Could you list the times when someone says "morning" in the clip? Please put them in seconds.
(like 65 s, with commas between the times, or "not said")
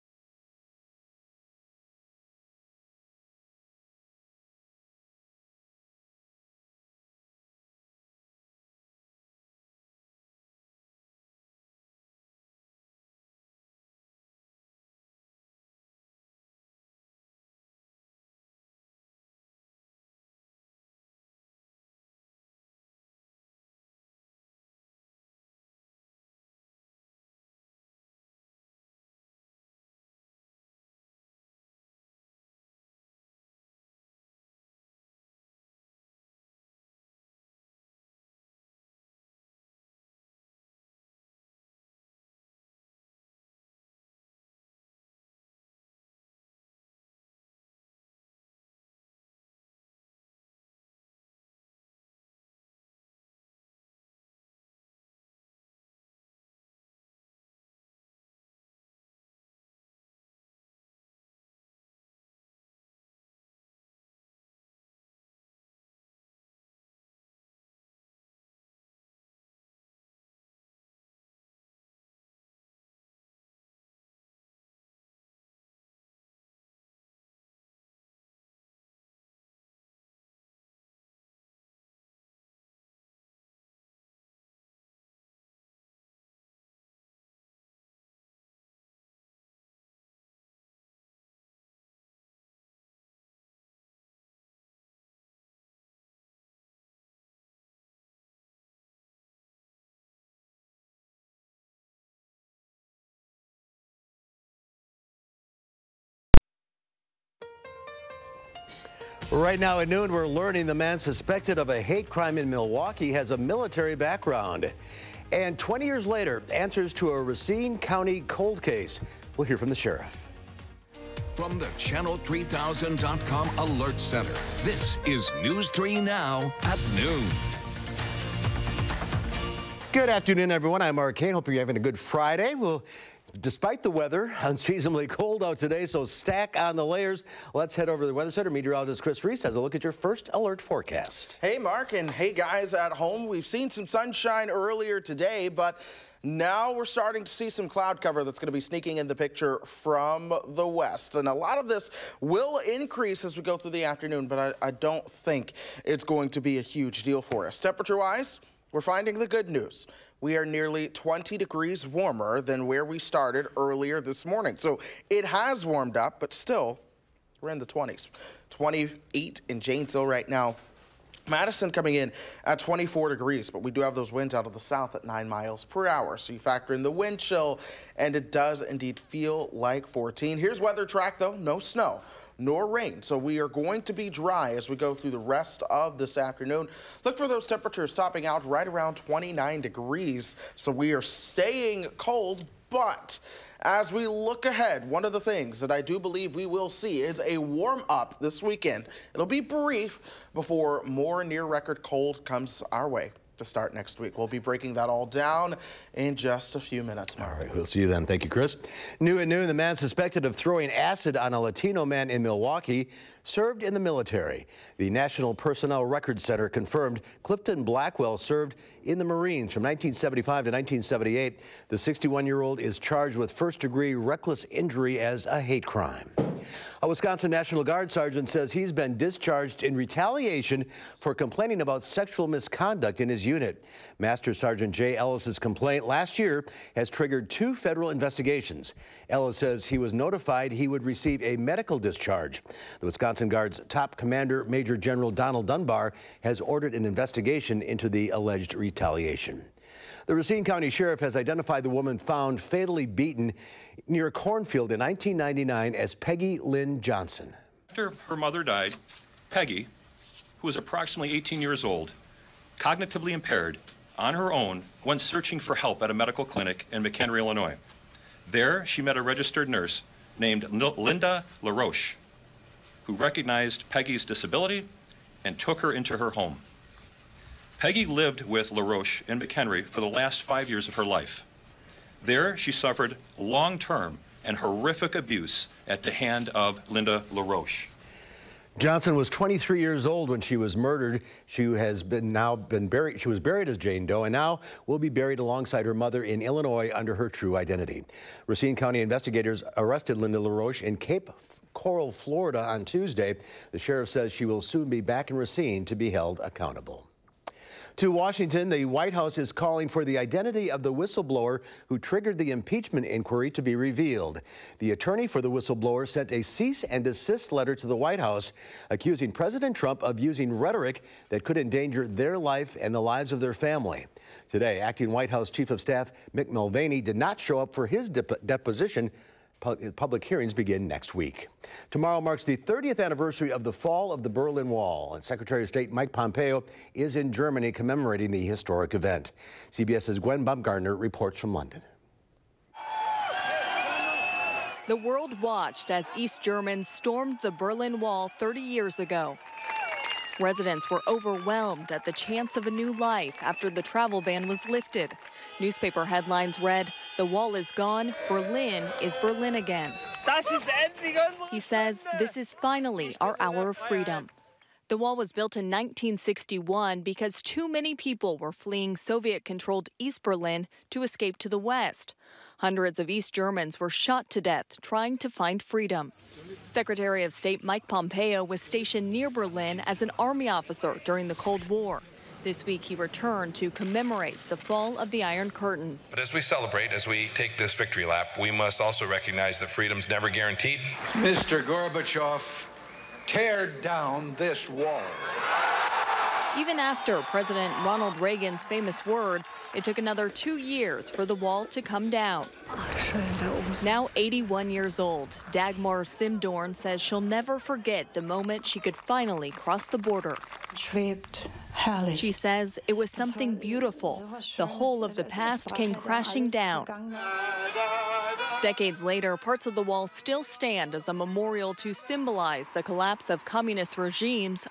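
164 s.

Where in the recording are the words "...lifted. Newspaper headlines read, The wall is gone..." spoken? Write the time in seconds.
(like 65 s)
354 s.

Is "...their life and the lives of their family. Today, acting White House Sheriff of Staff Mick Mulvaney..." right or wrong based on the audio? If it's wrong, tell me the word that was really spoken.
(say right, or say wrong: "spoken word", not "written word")
wrong: "Chief", not "Sheriff".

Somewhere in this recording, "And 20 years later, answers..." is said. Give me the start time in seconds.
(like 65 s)
115 s.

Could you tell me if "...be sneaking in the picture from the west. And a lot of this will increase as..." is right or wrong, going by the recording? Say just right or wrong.
right.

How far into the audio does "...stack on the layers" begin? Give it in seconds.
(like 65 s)
136 s.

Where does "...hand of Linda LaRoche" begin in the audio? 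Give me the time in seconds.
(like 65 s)
285 s.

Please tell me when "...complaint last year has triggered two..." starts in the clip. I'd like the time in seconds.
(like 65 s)
235 s.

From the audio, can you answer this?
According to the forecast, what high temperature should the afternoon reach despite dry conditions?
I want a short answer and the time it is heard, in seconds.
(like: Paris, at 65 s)
29 degrees, at 188 s.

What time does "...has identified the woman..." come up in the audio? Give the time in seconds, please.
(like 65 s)
251 s.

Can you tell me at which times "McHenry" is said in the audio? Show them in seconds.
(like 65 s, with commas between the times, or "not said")
266 s, 279 s.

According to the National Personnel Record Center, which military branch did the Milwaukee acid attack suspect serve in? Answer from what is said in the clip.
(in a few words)
Marines.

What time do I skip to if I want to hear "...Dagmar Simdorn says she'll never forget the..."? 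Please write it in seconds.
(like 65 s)
405 s.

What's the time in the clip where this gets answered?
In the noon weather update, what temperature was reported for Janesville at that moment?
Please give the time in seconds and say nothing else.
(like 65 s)
168 s.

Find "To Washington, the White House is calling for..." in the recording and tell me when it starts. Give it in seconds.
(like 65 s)
307 s.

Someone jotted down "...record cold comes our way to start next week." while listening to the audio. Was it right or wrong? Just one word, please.
right.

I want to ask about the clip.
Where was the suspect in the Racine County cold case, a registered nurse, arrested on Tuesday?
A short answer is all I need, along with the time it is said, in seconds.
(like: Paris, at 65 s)
Cape Coral, Florida, at 300 s.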